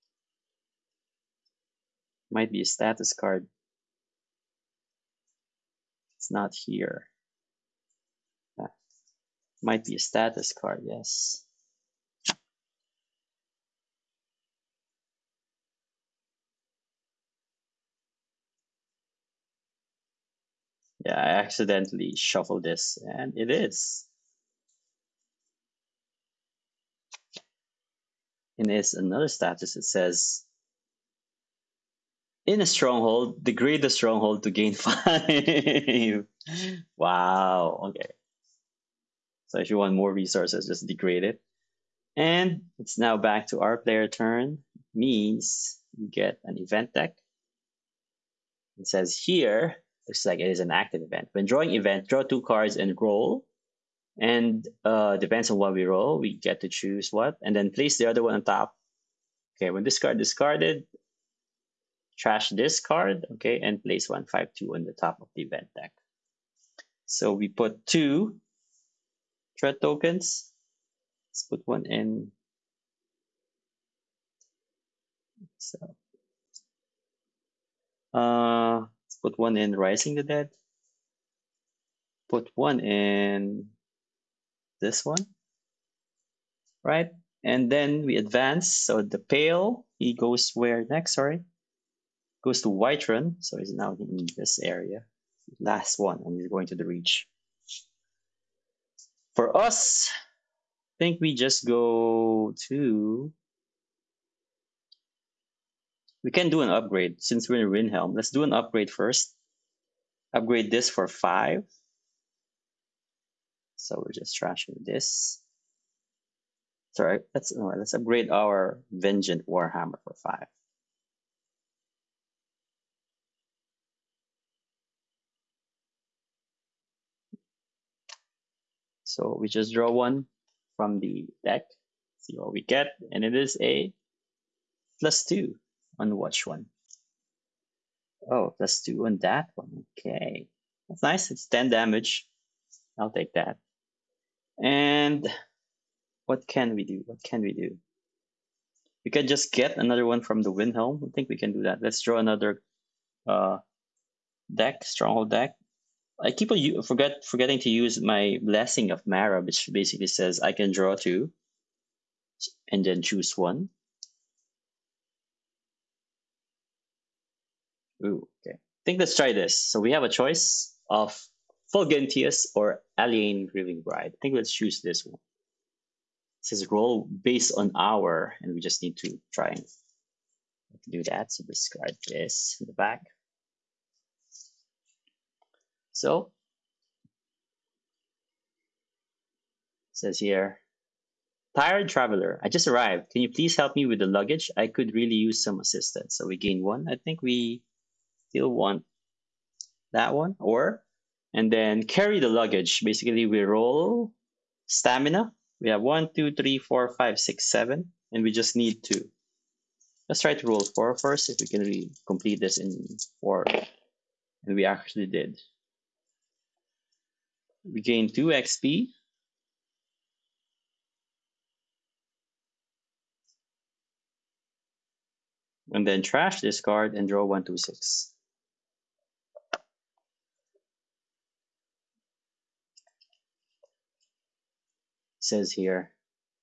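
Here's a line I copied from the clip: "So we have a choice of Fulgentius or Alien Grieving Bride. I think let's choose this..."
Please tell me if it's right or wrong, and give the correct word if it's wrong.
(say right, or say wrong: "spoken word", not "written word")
right.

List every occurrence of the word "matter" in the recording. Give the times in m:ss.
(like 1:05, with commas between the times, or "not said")
not said.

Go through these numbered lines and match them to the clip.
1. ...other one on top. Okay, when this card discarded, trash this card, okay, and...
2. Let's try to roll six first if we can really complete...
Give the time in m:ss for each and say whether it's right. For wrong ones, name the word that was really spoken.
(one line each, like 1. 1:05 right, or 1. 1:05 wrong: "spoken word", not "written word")
1. 0:58 right
2. 3:30 wrong: "four", not "six".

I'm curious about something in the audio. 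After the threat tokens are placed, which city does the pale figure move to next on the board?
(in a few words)
Whiterun.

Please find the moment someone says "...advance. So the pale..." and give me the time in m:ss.
1:28.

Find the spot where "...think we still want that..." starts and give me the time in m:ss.
3:16.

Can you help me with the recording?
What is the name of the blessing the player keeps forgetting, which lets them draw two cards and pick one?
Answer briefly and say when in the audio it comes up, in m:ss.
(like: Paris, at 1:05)
Blessing of Mara, at 2:38.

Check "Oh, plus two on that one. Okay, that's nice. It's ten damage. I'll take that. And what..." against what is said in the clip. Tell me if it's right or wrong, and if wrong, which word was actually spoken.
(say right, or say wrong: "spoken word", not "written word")
right.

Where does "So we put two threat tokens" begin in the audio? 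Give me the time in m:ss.
1:07.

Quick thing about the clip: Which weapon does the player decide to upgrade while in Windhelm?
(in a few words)
Vengeant Warhammer.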